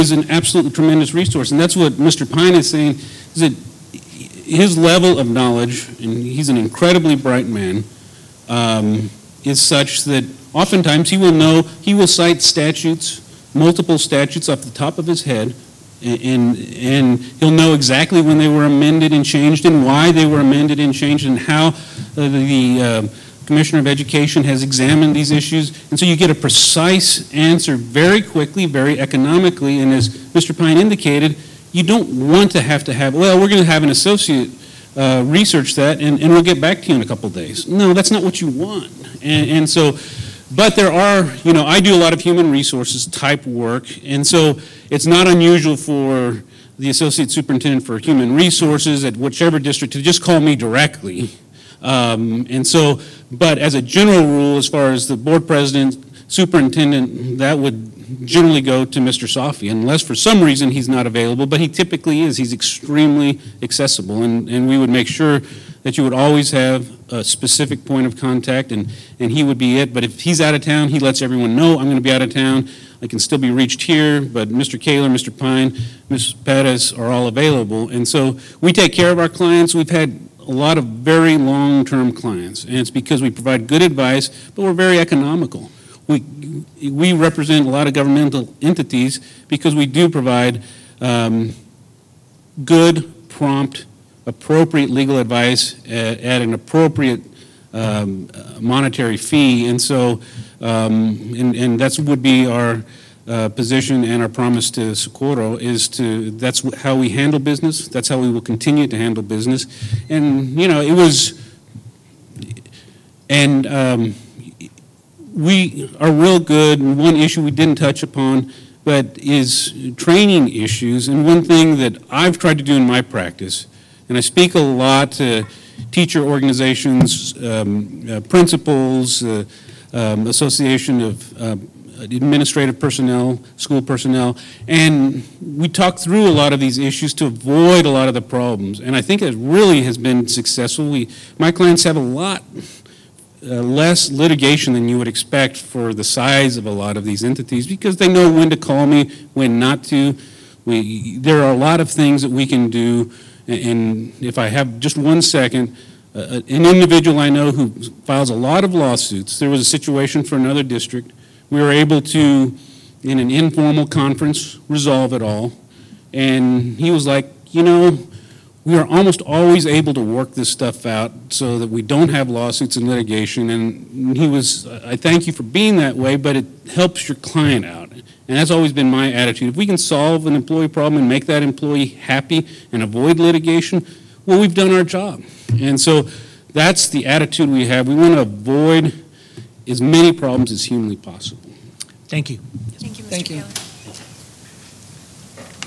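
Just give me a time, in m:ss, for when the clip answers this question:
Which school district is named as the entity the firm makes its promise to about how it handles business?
1:44.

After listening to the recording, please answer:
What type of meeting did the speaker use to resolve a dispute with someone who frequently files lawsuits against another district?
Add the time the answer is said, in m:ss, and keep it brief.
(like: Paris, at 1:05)
informal conference, at 2:43.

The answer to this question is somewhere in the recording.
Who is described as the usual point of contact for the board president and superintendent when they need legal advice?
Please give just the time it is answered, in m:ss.
0:58.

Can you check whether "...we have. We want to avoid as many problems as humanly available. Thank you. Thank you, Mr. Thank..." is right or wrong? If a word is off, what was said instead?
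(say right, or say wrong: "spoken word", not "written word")
wrong: "possible", not "available".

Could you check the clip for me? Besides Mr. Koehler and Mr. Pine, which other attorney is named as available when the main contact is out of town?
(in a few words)
Ms. Perez.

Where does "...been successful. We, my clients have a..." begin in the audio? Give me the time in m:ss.
2:19.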